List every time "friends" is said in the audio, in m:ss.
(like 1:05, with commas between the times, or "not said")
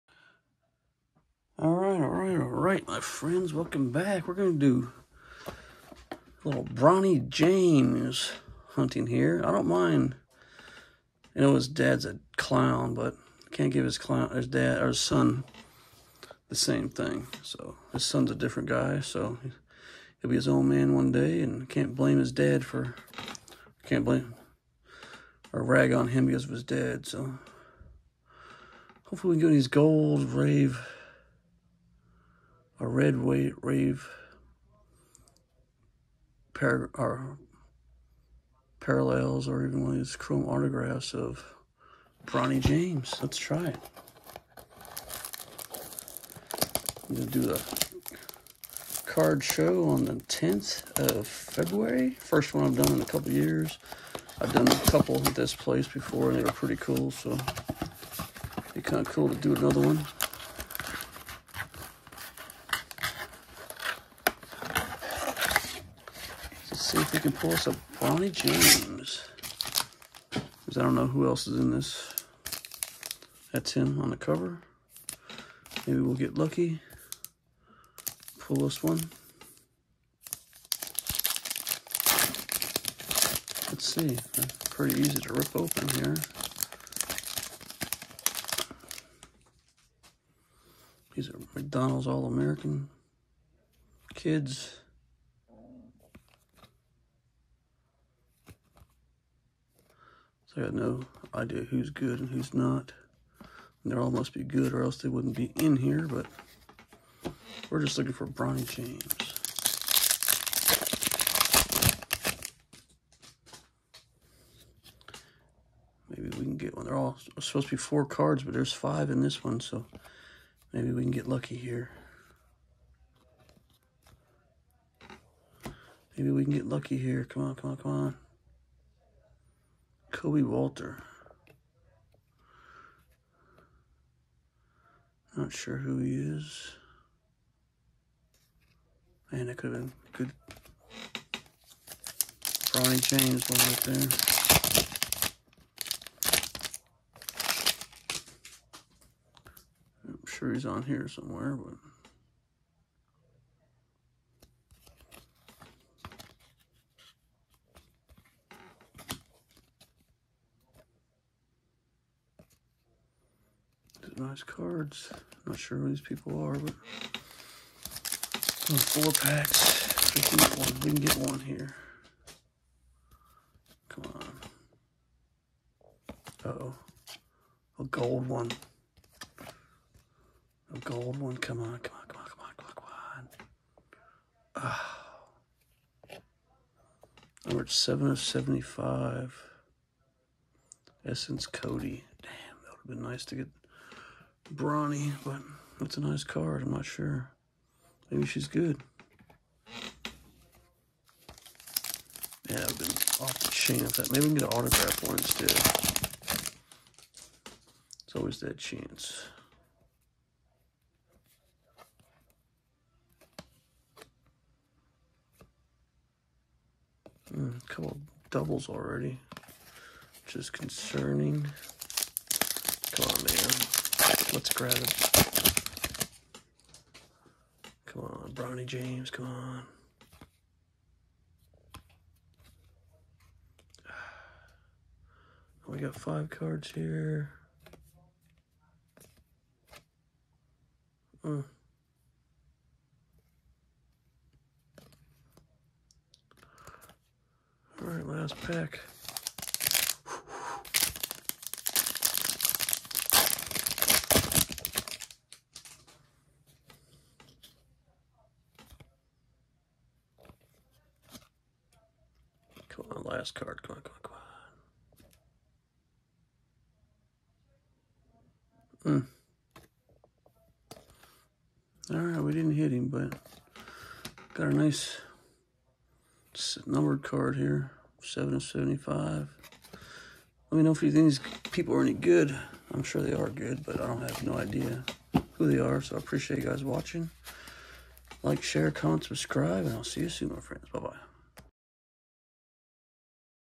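0:03, 4:50.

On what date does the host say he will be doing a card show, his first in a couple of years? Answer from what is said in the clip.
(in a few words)
February 10.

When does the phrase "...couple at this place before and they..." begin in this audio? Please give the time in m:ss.
0:54.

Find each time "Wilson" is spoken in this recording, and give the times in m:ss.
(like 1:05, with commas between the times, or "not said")
not said.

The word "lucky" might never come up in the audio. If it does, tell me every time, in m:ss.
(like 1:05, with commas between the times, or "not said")
1:16, 2:01, 2:06.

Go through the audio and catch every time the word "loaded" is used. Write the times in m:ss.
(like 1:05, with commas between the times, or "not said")
not said.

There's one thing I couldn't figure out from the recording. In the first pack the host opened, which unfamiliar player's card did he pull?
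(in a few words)
Kobe Walter.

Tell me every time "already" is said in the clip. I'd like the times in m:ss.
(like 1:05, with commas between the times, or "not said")
3:38.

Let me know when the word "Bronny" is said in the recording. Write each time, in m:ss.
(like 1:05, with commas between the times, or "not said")
0:06, 0:42, 1:07, 1:48, 2:22, 3:14, 3:48.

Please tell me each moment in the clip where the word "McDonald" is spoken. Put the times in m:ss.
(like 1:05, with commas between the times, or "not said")
1:31.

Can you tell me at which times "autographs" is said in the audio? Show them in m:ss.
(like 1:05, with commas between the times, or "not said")
0:40, 3:24.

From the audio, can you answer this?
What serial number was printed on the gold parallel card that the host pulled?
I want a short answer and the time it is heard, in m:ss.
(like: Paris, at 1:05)
7 of 75, at 3:07.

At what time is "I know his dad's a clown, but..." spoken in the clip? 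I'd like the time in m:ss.
0:11.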